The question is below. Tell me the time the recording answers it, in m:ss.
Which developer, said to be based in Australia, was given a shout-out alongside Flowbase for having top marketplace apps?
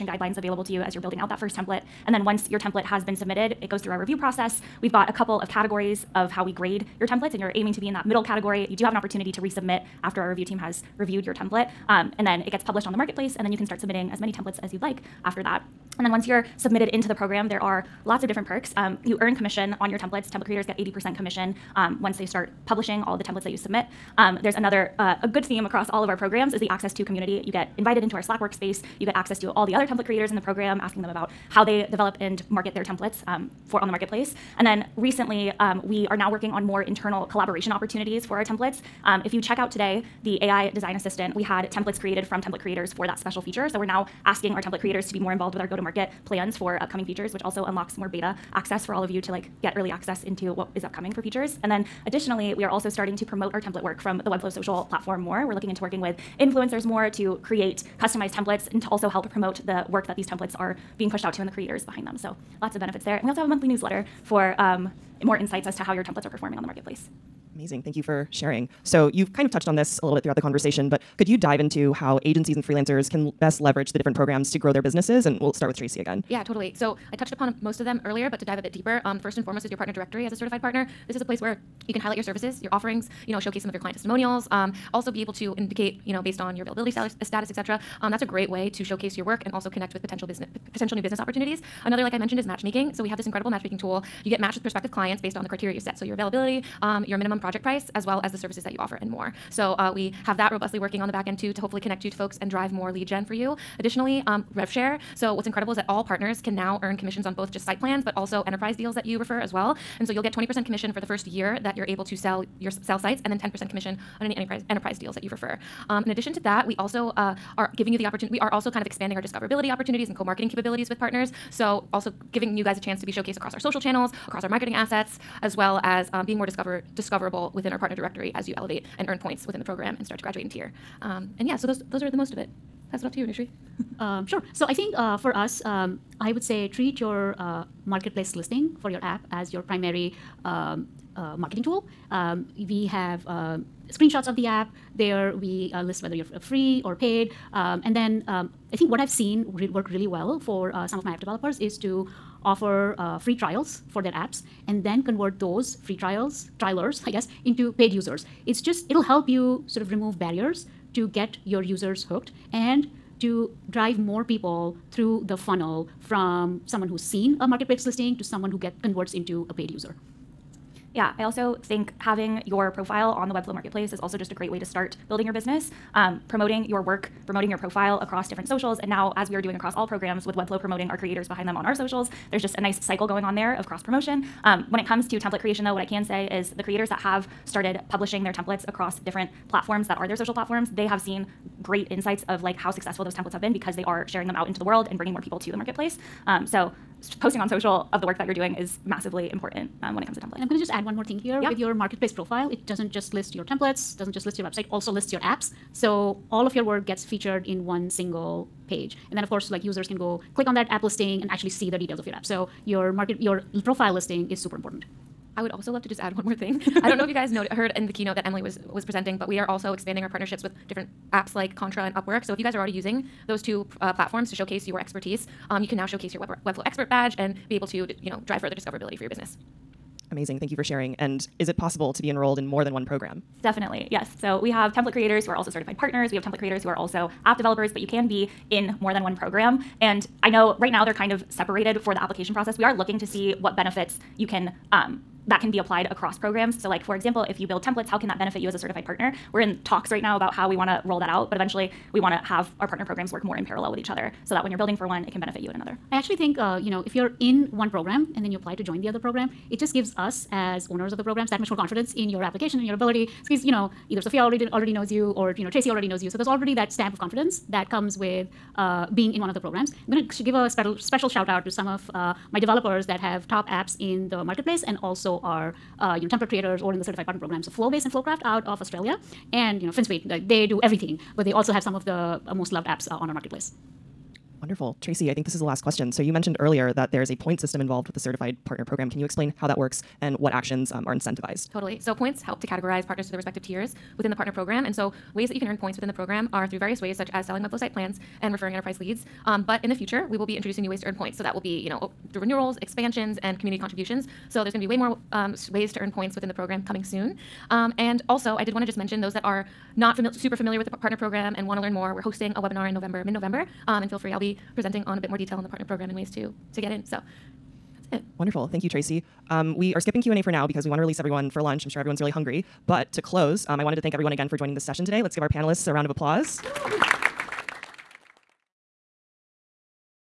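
4:37.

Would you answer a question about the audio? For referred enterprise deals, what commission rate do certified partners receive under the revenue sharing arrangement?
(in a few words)
10%.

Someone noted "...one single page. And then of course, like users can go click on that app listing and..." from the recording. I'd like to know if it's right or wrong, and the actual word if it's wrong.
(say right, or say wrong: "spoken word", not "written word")
right.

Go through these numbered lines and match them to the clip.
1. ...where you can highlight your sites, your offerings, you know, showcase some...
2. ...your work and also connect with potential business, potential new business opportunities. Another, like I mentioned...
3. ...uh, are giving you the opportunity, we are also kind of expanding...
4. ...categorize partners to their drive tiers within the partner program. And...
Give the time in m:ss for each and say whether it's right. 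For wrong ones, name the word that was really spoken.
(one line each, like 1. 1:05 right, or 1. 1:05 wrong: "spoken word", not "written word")
1. 1:21 wrong: "services", not "sites"
2. 1:29 right
3. 1:57 right
4. 4:52 wrong: "respective", not "drive".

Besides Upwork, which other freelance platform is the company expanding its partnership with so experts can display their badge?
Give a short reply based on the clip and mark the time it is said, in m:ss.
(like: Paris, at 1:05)
Contra, at 3:41.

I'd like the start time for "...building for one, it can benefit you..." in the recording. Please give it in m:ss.
4:14.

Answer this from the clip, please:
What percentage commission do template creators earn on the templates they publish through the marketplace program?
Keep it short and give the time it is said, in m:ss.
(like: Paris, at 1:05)
80%, at 0:20.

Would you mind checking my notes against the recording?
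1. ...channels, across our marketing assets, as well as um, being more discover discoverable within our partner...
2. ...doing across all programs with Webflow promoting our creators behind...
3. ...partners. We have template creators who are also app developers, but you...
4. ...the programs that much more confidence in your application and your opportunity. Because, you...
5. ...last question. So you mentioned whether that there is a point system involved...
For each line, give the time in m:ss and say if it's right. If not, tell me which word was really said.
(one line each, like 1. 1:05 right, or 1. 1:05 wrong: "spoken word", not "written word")
1. 2:03 right
2. 2:59 right
3. 3:55 right
4. 4:20 wrong: "ability", not "opportunity"
5. 4:45 wrong: "earlier", not "whether".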